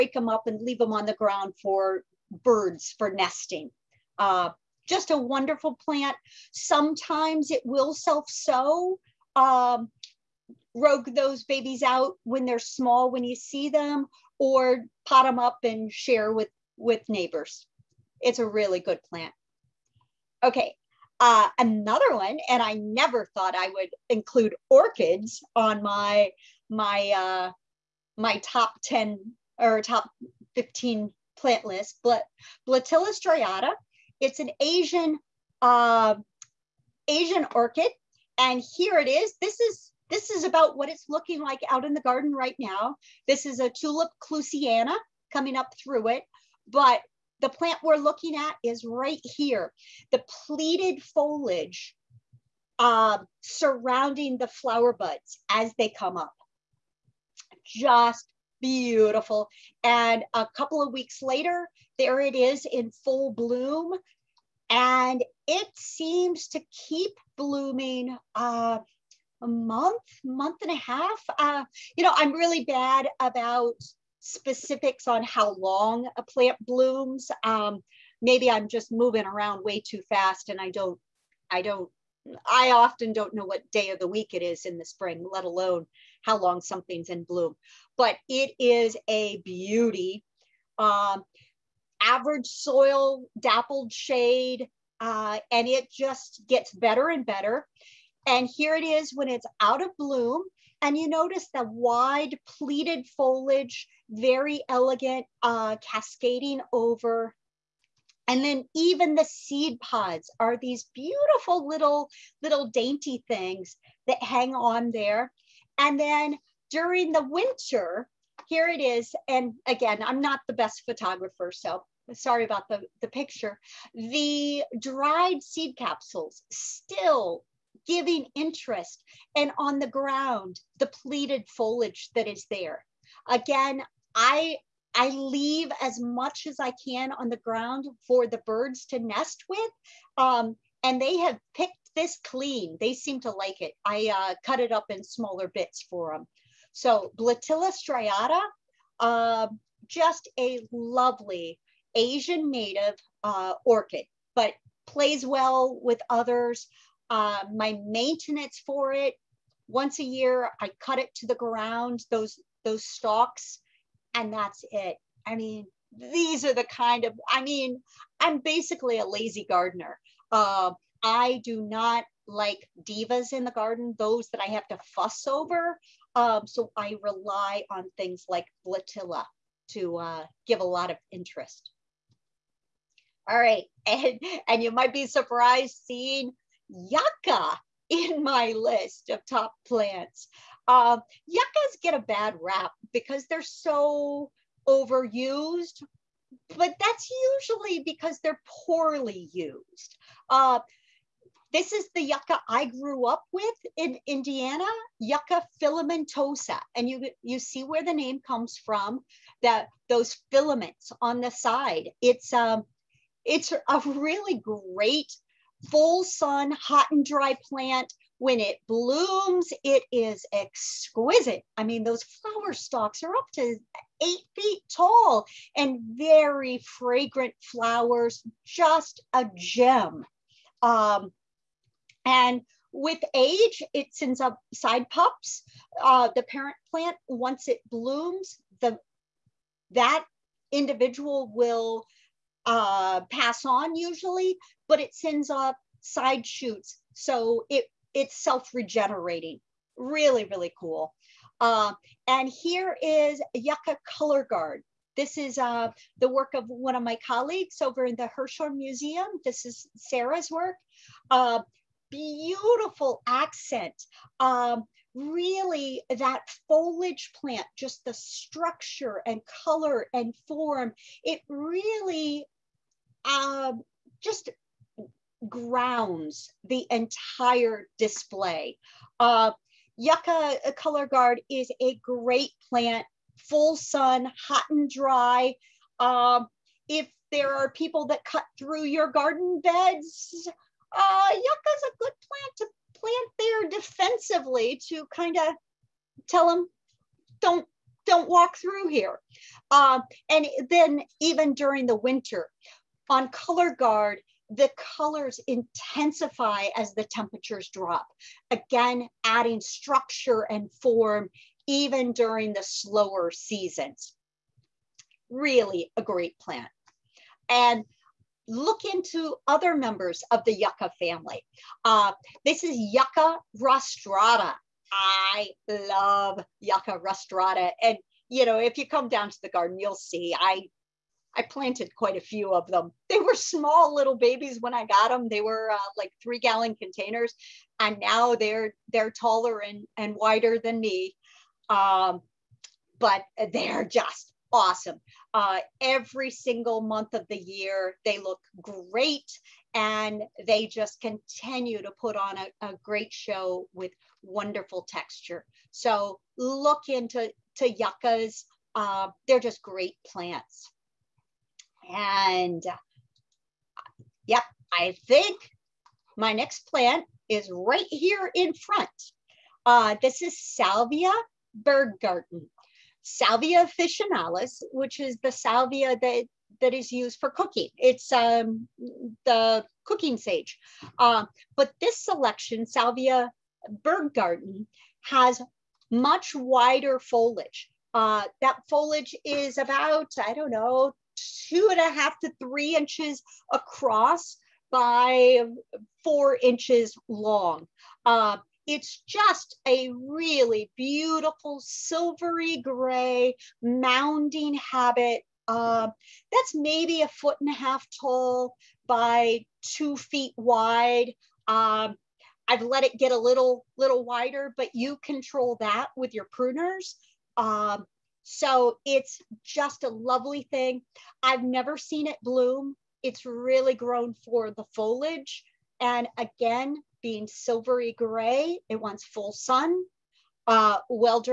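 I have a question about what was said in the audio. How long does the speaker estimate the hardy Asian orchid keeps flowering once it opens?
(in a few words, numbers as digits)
a month, month and a half.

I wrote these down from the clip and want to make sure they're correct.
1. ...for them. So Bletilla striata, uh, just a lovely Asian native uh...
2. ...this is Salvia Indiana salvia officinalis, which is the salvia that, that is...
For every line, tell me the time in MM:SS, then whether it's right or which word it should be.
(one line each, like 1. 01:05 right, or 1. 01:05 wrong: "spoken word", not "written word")
1. 02:25 right
2. 06:09 wrong: "Berggarten", not "Indiana".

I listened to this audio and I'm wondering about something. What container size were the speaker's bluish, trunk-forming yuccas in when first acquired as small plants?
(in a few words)
3 gallon.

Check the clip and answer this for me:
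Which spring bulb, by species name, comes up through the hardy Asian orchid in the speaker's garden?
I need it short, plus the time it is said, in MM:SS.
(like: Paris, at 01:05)
Tulip clusiana, at 00:43.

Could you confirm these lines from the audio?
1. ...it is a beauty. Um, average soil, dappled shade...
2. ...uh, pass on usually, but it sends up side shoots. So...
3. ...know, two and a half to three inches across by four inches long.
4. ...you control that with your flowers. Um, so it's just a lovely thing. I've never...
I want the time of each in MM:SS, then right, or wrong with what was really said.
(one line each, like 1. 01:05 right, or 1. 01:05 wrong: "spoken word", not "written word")
1. 01:28 right
2. 04:02 right
3. 06:30 right
4. 06:54 wrong: "pruners", not "flowers".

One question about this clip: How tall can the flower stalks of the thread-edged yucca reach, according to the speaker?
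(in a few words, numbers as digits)
8 feet.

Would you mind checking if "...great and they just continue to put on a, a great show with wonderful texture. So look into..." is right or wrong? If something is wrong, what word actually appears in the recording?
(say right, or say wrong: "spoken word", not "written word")
right.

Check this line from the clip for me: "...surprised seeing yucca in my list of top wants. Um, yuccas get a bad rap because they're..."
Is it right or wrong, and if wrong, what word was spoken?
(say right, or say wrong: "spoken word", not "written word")
wrong: "plants", not "wants".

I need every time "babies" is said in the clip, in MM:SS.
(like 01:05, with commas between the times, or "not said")
00:11, 05:33.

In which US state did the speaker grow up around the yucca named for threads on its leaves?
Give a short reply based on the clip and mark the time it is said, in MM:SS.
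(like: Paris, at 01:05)
Indiana, at 03:24.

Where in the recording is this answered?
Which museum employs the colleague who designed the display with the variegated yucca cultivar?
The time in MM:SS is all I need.
04:18.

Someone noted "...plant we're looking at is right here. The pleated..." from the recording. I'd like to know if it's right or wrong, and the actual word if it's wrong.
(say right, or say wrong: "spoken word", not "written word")
right.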